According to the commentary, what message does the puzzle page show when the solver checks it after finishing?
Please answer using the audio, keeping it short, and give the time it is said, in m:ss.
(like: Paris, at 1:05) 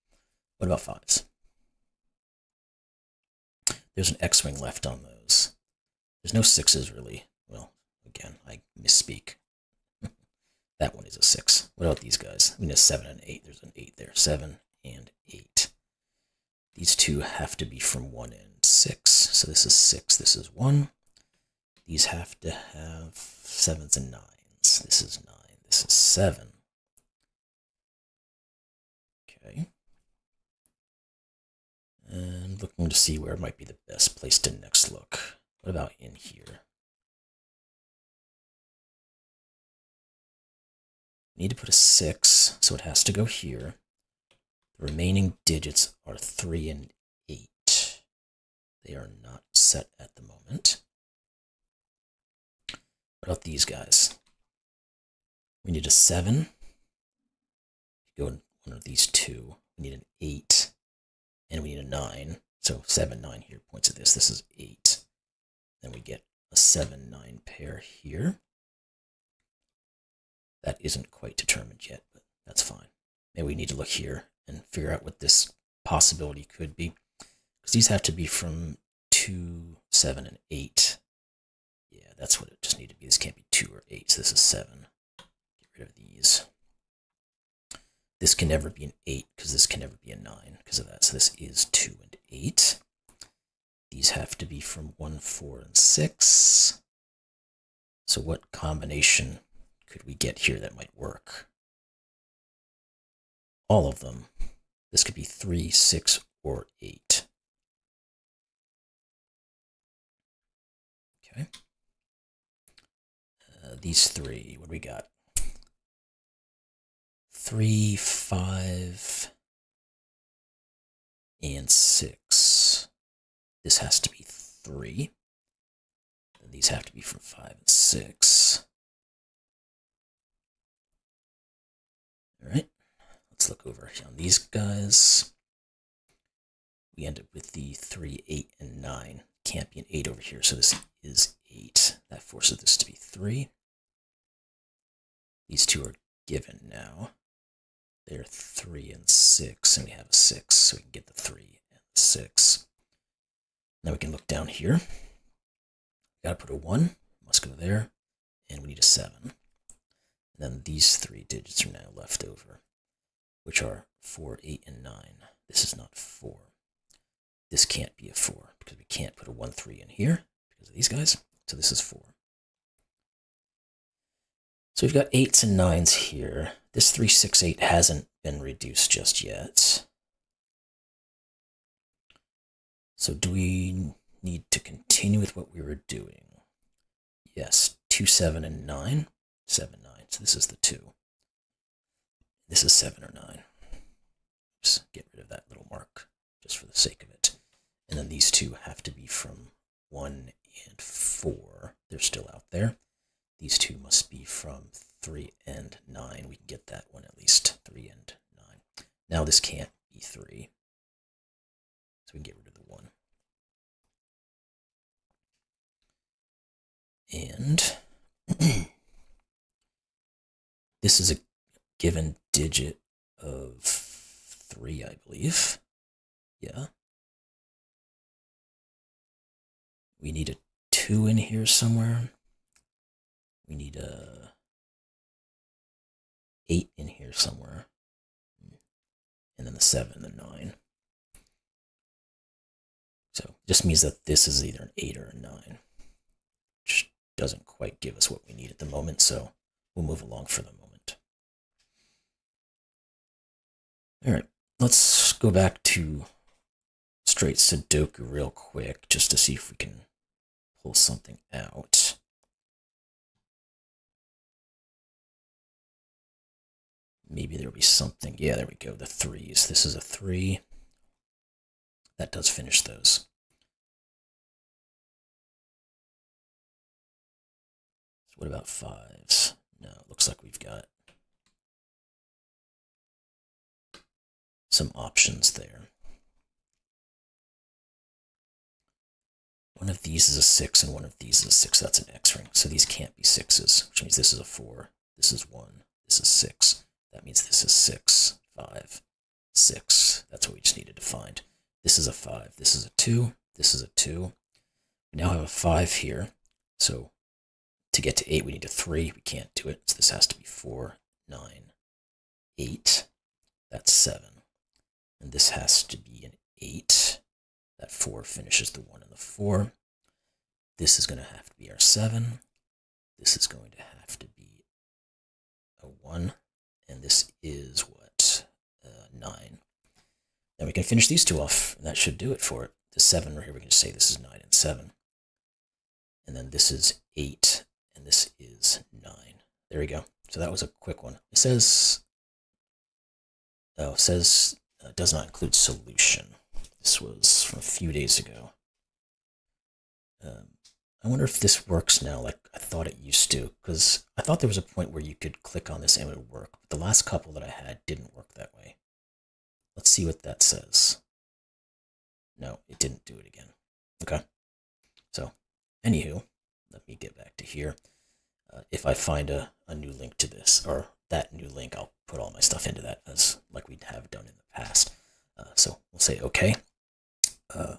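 does not include solution, at 5:44.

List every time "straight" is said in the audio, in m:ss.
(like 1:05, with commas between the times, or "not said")
4:17.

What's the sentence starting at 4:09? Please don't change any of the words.
So we'll move along for the moment.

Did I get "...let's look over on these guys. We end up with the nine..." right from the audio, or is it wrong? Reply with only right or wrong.
wrong.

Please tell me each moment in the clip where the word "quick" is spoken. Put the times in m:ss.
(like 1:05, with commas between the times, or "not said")
4:18, 5:40.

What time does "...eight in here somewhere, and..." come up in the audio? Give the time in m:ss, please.
3:56.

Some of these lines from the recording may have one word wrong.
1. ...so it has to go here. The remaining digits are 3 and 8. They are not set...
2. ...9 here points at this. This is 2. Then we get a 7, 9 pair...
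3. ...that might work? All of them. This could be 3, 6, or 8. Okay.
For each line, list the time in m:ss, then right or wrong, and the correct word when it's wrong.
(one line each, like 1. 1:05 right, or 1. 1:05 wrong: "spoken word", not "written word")
1. 0:42 right
2. 1:03 wrong: "8", not "2"
3. 1:40 right.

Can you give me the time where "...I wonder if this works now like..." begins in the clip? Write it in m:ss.
5:50.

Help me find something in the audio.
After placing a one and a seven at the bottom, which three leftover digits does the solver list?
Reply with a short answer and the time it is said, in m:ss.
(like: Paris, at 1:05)
4, 8, and 9, at 2:44.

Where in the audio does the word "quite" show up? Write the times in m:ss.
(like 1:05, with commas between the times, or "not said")
1:11, 4:07.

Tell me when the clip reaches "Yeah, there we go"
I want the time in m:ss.
4:28.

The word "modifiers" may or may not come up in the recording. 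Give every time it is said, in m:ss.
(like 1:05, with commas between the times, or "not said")
not said.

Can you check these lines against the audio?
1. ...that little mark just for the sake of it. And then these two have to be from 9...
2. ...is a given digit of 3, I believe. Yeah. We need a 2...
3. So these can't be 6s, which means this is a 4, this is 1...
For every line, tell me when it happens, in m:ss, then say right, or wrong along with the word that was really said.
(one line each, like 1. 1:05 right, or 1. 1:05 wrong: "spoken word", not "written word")
1. 3:15 wrong: "1", not "9"
2. 3:41 right
3. 4:52 right.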